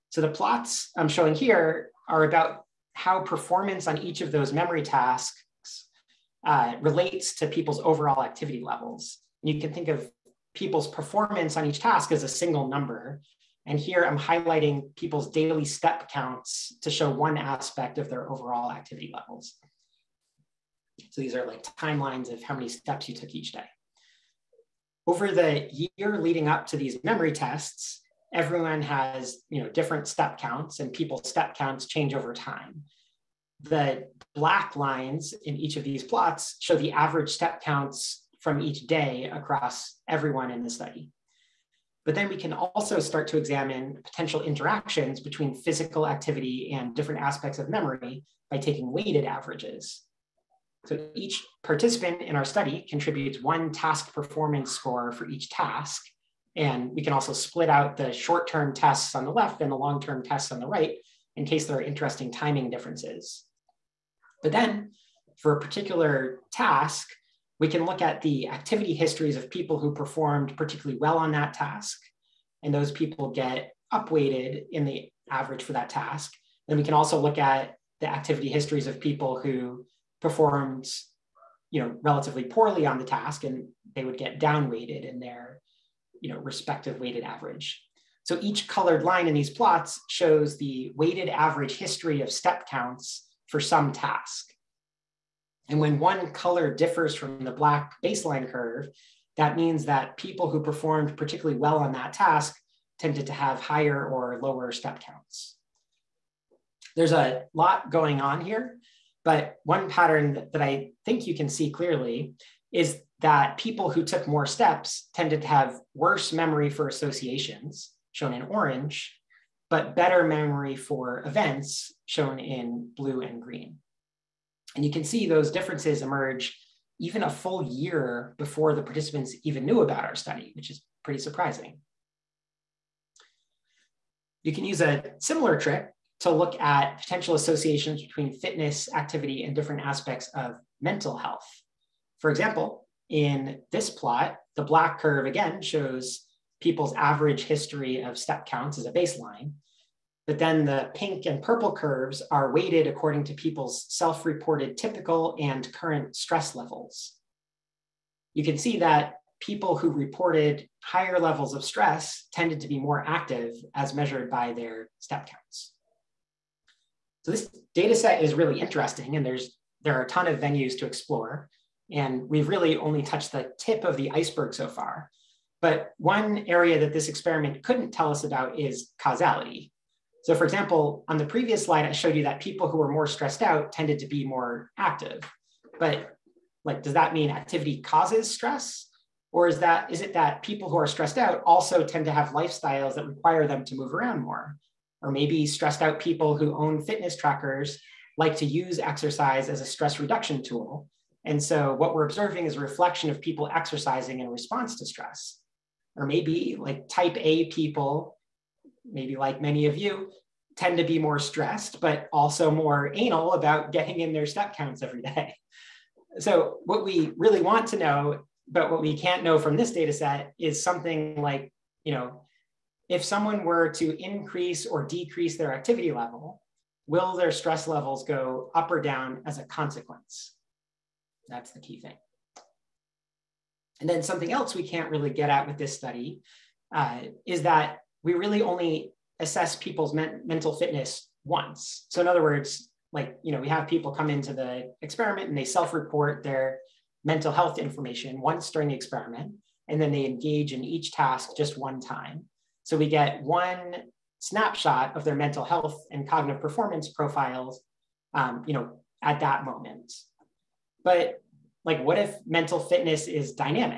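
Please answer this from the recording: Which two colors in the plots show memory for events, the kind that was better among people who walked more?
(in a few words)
blue and green.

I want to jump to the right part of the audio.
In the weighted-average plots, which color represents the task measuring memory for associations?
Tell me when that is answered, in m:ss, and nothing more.
1:58.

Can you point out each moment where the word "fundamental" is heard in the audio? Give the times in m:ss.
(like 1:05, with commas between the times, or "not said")
not said.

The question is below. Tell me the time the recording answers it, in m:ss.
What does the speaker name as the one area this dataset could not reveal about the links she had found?
2:59.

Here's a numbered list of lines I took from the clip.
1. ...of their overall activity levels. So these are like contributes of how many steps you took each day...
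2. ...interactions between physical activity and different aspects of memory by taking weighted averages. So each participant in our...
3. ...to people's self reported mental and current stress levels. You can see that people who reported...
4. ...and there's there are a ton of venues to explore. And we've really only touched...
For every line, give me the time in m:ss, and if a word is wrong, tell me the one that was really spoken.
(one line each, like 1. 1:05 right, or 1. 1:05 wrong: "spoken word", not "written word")
1. 0:17 wrong: "timelines", not "contributes"
2. 0:44 right
3. 2:33 wrong: "typical", not "mental"
4. 2:49 right.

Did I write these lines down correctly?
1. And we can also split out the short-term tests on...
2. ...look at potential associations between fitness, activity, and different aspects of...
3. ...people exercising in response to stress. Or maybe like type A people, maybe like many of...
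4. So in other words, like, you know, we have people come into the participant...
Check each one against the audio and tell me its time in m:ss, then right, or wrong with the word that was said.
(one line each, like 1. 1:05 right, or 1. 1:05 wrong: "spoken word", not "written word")
1. 0:56 right
2. 2:16 right
3. 3:23 right
4. 4:01 wrong: "experiment", not "participant".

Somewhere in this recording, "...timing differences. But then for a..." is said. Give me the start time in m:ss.
1:02.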